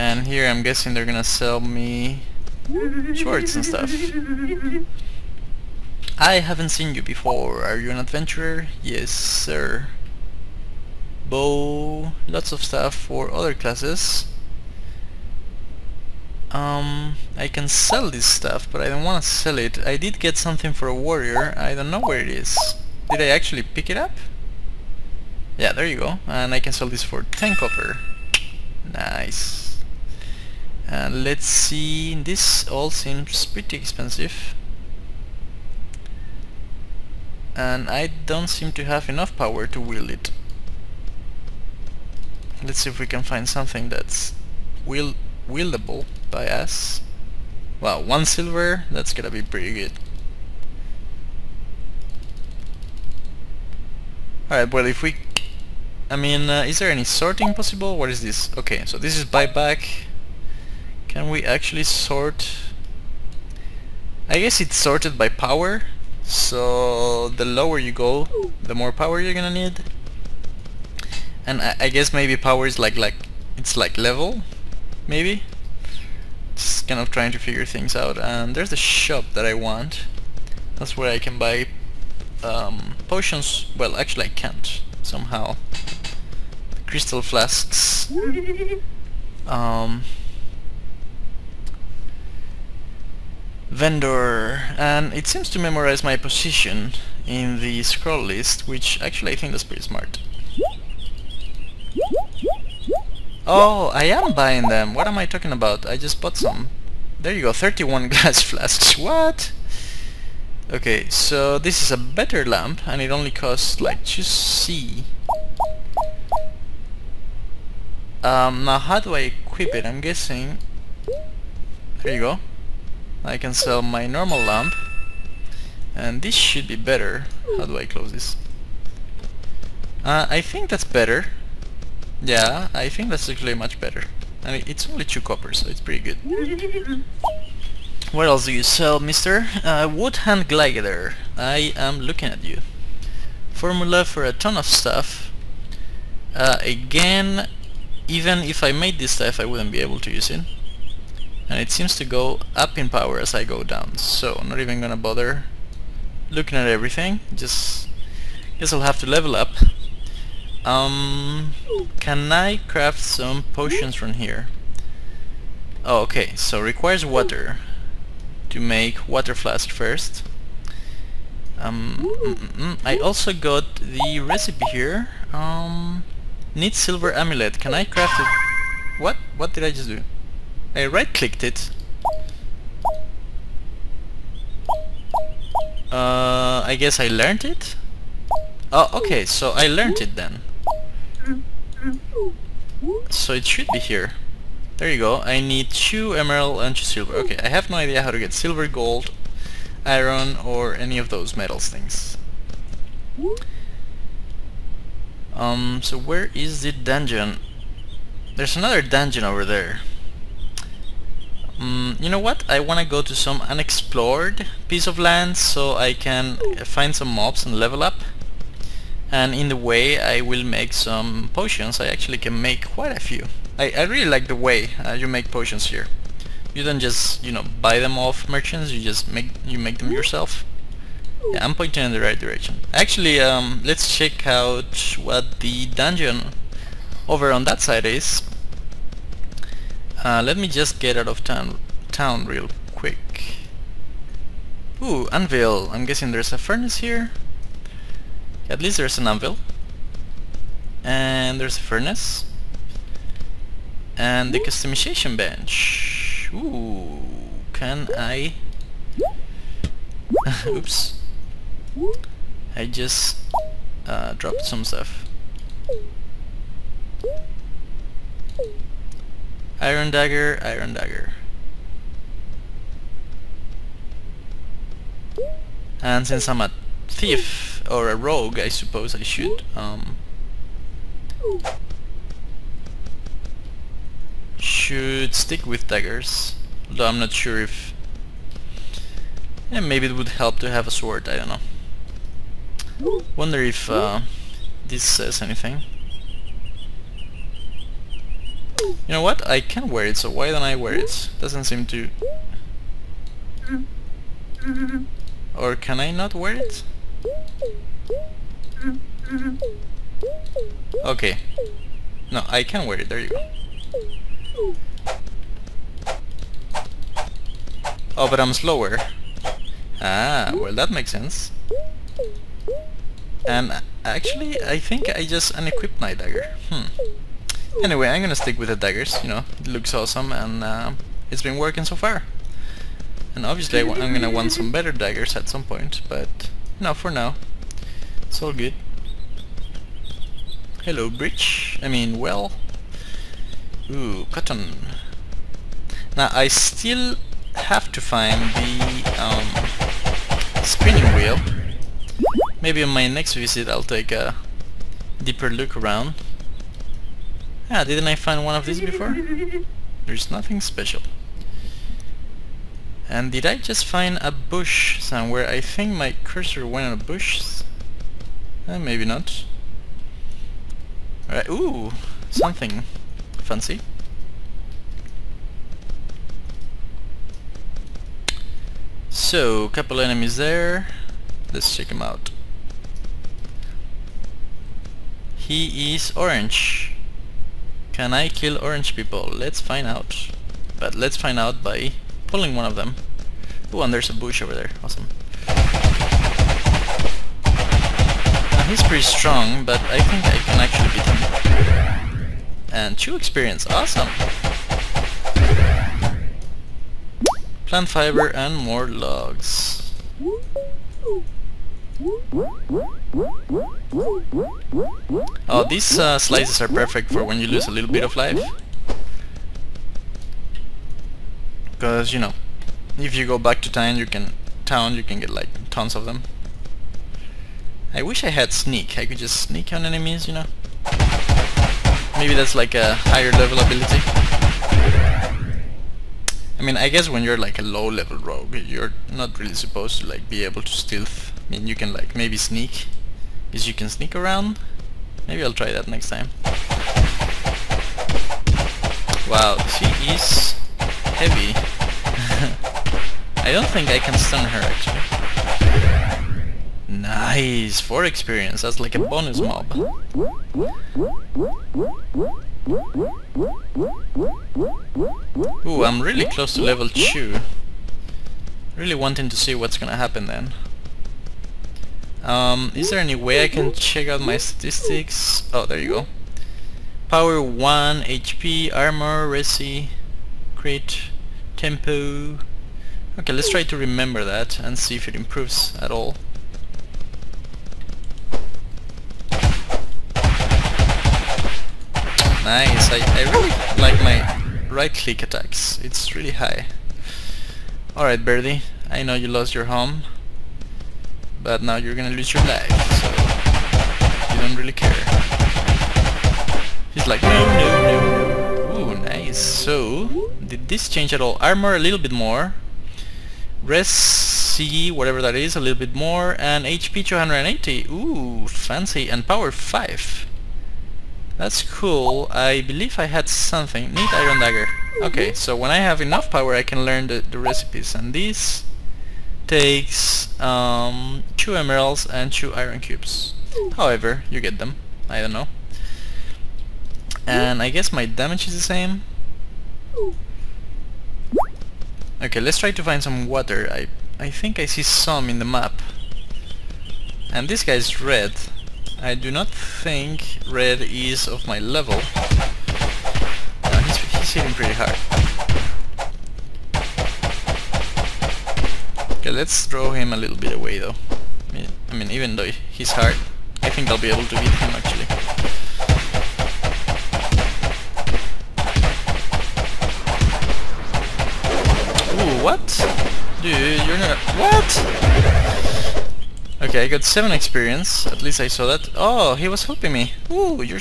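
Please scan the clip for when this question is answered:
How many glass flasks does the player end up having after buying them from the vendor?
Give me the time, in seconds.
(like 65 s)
107 s.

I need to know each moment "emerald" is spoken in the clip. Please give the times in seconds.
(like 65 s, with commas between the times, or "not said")
196 s, 531 s.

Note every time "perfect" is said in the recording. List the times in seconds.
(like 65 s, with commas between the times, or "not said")
416 s.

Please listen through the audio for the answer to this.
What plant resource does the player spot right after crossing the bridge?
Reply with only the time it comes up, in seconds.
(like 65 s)
344 s.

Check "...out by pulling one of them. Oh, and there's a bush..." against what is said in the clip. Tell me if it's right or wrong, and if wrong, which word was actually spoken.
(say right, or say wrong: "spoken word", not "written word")
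right.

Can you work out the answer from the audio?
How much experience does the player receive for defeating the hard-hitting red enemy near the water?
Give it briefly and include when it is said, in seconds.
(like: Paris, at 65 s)
7, at 576 s.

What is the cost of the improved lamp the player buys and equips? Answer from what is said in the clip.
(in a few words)
2 copper.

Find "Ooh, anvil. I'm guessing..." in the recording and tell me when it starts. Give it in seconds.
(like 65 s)
244 s.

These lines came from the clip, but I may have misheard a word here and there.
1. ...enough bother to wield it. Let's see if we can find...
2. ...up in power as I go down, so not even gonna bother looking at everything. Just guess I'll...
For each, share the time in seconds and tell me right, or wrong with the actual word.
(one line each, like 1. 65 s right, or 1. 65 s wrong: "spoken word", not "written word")
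1. 39 s wrong: "power", not "bother"
2. 152 s right.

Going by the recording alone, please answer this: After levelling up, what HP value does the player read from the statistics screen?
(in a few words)
280.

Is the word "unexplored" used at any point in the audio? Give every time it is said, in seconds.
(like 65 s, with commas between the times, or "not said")
213 s.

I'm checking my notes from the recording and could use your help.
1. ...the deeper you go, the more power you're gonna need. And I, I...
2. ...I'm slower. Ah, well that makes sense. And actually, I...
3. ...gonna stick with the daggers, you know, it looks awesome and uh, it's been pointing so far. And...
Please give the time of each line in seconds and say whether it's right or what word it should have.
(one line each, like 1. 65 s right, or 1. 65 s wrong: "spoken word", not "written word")
1. 67 s wrong: "lower", not "deeper"
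2. 318 s right
3. 328 s wrong: "working", not "pointing".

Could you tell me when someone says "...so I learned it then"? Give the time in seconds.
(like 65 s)
189 s.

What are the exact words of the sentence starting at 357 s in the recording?
Ah, didn't I find one of these before?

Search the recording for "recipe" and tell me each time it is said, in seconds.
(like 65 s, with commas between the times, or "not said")
174 s, 527 s.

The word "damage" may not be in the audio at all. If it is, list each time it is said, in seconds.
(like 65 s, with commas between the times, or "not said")
537 s.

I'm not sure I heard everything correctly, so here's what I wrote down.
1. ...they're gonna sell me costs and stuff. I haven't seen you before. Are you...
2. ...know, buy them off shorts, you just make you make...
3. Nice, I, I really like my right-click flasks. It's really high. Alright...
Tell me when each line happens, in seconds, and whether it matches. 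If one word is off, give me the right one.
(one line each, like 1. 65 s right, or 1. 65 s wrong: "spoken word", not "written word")
1. 0 s wrong: "shorts", not "costs"
2. 227 s wrong: "merchants", not "shorts"
3. 492 s wrong: "attacks", not "flasks".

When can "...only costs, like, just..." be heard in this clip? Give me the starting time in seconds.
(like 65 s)
113 s.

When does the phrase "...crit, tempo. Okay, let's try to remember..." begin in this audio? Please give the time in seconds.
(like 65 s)
480 s.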